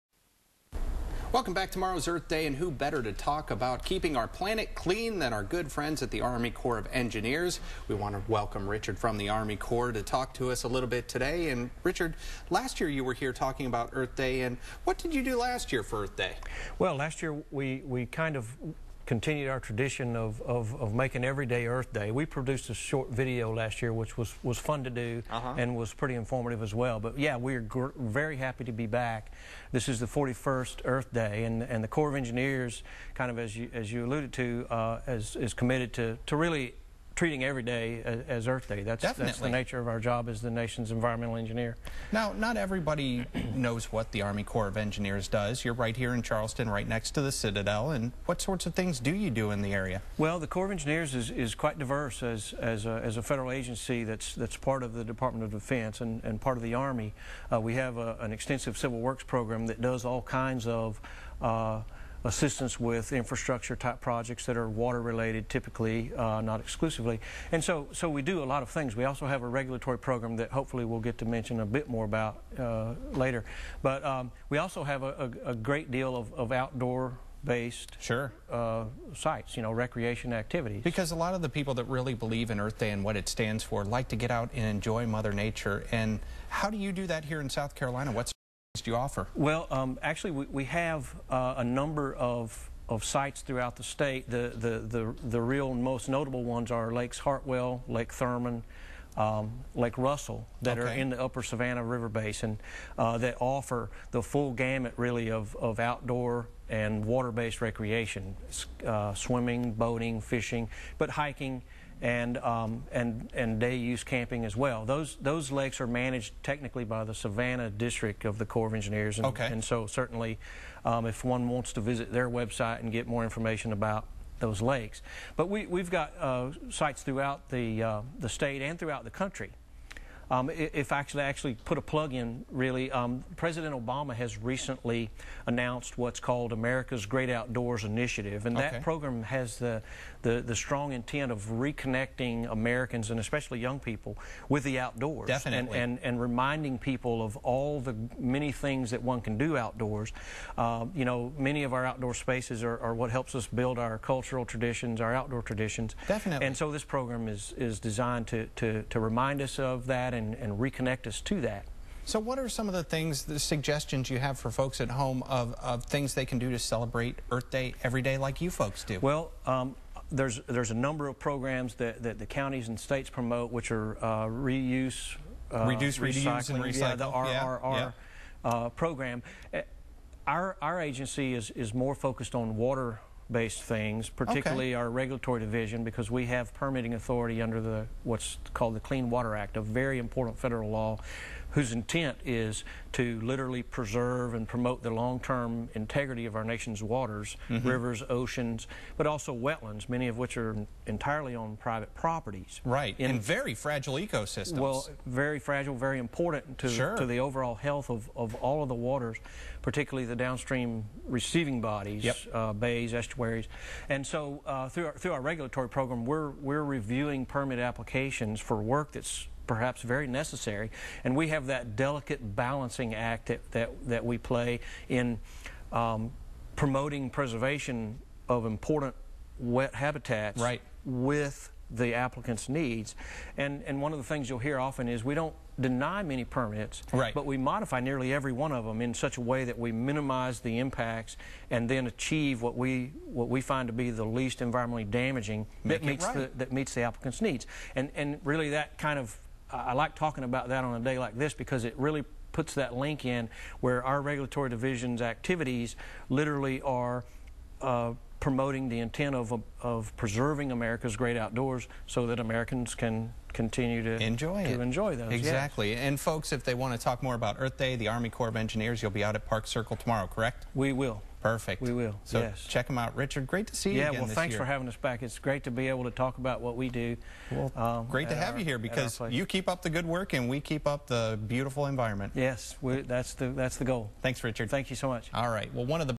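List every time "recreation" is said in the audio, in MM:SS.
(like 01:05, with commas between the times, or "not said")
01:19, 01:47.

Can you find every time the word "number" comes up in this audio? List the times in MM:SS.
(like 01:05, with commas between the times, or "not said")
01:31, 02:50.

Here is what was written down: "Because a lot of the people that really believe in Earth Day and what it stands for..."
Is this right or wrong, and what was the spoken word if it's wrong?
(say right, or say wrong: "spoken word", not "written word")
right.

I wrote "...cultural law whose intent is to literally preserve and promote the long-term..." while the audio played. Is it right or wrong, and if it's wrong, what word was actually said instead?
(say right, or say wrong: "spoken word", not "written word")
wrong: "federal", not "cultural".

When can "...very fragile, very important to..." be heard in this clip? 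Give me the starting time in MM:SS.
03:25.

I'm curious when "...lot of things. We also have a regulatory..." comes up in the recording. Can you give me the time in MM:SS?
01:08.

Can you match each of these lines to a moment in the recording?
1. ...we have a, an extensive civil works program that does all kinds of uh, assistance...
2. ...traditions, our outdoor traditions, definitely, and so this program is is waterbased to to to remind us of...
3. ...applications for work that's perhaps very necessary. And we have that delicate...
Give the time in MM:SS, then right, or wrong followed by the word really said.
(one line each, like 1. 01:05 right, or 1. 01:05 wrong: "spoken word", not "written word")
1. 00:57 right
2. 02:34 wrong: "designed", not "waterbased"
3. 03:37 right.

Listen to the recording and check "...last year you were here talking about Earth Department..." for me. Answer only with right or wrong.
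wrong.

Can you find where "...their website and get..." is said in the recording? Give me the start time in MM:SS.
02:02.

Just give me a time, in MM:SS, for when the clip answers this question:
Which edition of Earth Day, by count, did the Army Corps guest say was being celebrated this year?
00:30.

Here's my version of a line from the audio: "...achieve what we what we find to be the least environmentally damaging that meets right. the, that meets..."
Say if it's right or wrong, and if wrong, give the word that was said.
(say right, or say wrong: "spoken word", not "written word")
right.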